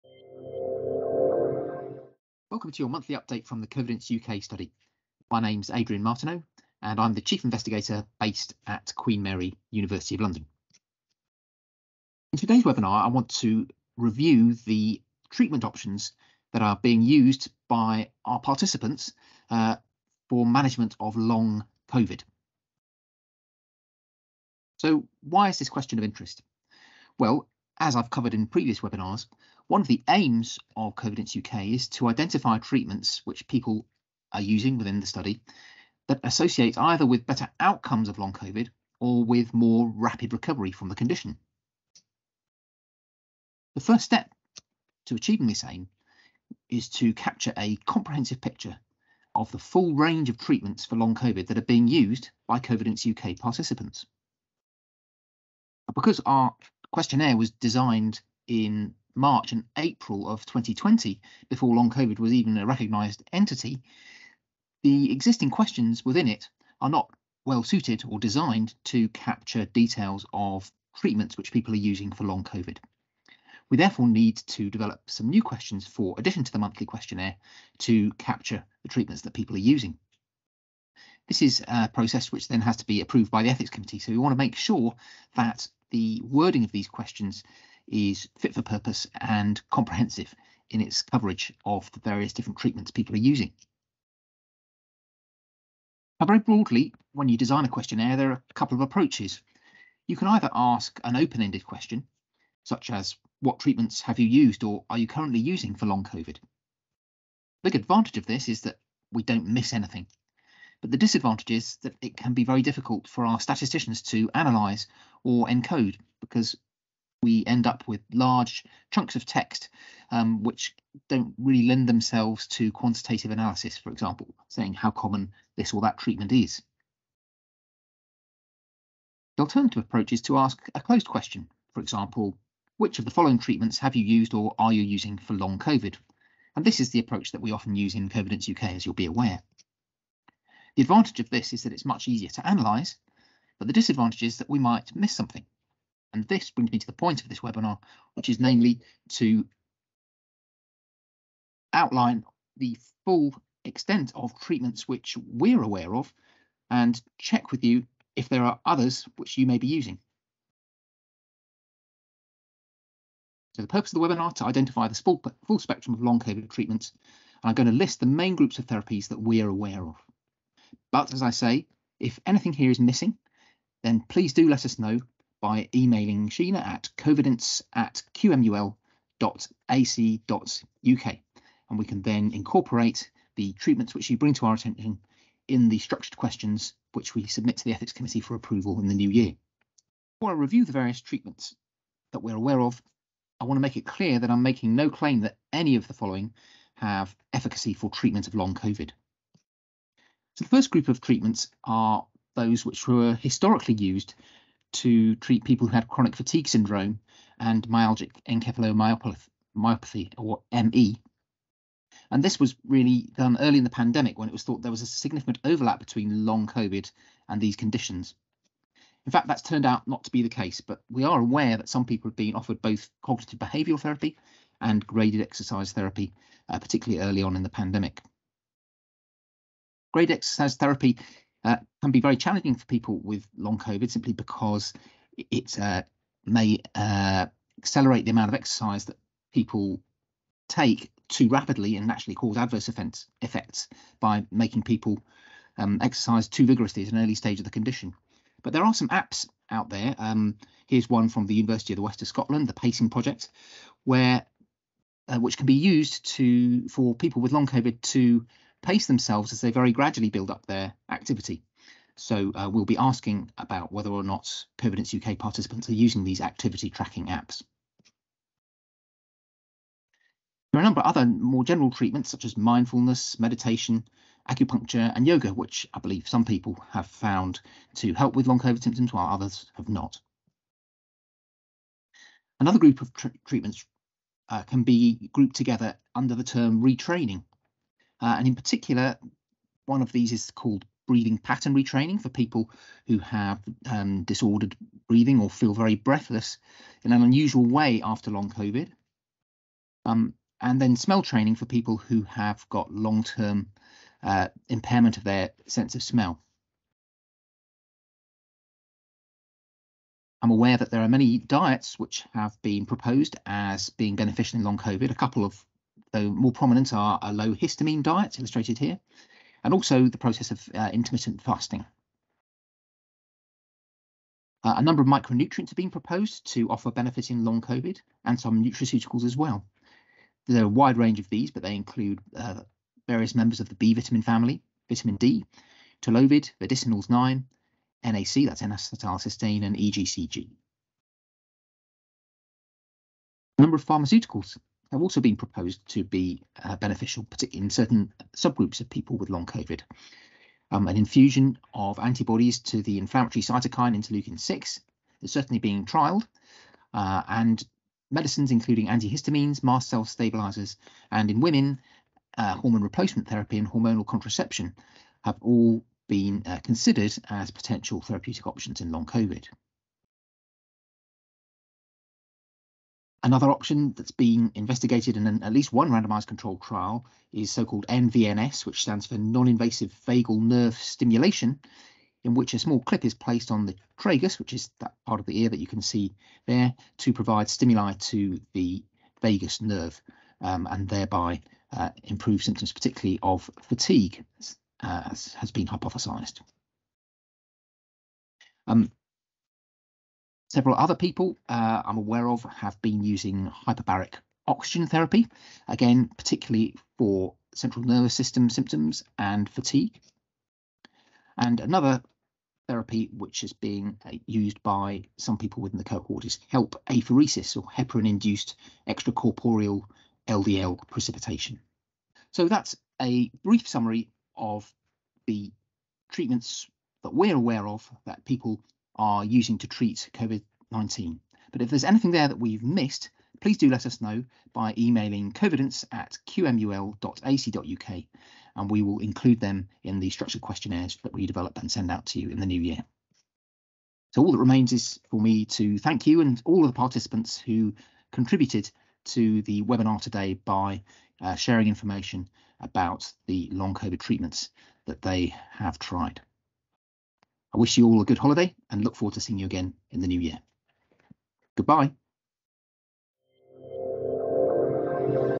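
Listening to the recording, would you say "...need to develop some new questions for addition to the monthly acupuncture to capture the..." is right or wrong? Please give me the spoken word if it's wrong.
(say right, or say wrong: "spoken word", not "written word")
wrong: "questionnaire", not "acupuncture".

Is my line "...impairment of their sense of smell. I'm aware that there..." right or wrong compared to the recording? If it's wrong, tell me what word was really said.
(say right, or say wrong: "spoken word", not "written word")
right.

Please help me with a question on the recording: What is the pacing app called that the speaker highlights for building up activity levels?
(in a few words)
the Pacing Project.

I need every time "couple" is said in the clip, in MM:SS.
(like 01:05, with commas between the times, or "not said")
01:38, 05:14.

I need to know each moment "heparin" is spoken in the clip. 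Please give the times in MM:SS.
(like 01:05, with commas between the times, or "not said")
06:57.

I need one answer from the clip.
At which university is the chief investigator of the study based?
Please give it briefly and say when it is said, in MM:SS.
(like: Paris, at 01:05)
Queen Mary, University of London, at 00:08.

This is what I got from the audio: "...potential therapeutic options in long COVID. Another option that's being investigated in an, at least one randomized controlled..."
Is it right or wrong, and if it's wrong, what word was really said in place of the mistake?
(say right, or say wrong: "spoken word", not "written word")
right.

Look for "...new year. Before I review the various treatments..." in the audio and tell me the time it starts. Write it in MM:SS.
03:08.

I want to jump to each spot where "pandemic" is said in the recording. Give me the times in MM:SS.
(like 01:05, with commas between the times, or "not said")
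03:33, 03:47.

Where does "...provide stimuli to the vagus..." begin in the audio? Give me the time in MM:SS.
06:26.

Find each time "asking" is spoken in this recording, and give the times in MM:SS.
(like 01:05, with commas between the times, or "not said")
04:22.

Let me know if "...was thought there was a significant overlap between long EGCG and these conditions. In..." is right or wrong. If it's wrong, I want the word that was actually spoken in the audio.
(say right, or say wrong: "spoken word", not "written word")
wrong: "COVID", not "EGCG".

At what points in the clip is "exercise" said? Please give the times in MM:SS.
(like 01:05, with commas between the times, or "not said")
03:45, 03:50, 03:58, 04:05.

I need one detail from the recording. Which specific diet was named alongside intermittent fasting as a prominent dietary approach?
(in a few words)
low histamine diet.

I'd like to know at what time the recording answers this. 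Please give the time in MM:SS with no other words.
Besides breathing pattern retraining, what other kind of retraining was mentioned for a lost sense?
05:00.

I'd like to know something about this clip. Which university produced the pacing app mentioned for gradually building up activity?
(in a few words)
University of the West of Scotland.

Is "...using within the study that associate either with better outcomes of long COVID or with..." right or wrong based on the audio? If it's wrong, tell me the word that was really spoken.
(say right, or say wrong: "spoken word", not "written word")
right.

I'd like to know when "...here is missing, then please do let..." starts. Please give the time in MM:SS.
02:52.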